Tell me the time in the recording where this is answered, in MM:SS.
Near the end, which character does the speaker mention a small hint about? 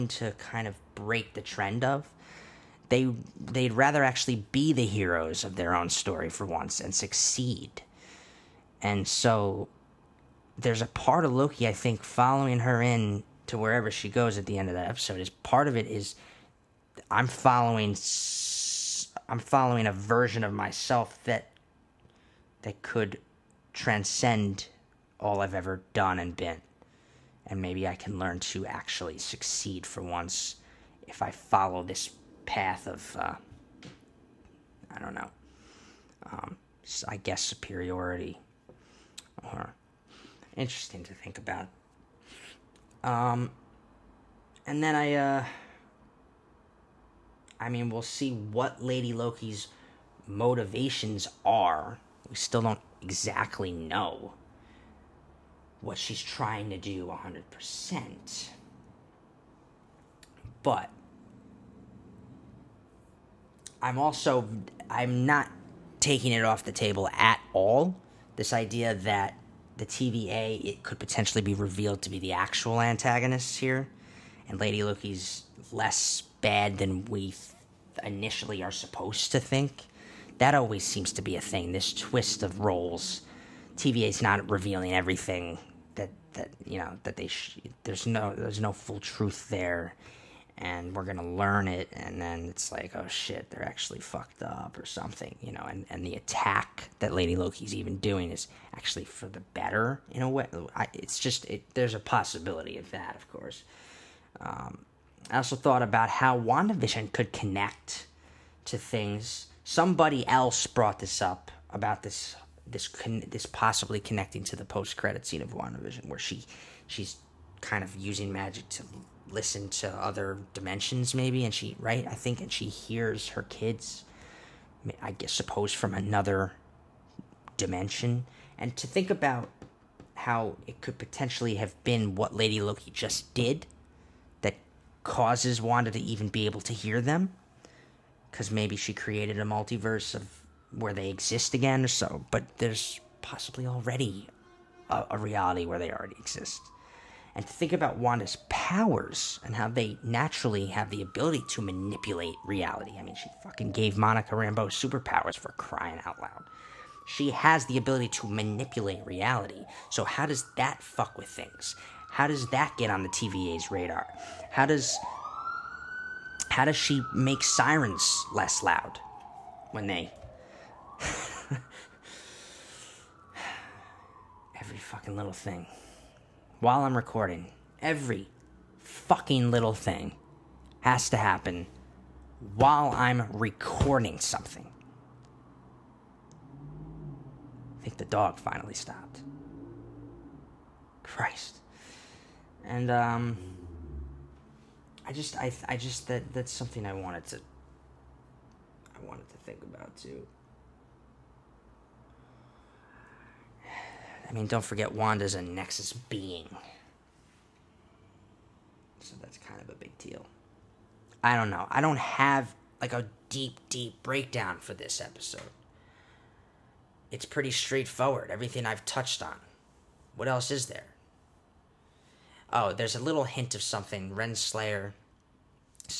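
03:44.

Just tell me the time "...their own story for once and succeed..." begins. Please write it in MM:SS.
00:05.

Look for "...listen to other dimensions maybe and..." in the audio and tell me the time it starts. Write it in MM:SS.
01:59.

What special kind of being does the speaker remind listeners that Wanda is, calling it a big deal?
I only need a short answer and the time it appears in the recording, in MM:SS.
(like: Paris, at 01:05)
Nexus being, at 03:25.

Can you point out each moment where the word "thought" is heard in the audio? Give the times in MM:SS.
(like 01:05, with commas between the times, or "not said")
01:45.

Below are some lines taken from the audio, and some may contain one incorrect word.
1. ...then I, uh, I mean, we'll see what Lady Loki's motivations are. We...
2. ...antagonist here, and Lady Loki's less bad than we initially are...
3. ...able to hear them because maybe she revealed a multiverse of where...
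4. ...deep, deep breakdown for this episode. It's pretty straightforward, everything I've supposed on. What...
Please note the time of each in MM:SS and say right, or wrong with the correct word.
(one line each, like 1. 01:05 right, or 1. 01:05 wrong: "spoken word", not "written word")
1. 00:44 right
2. 01:12 right
3. 02:16 wrong: "created", not "revealed"
4. 03:33 wrong: "touched", not "supposed".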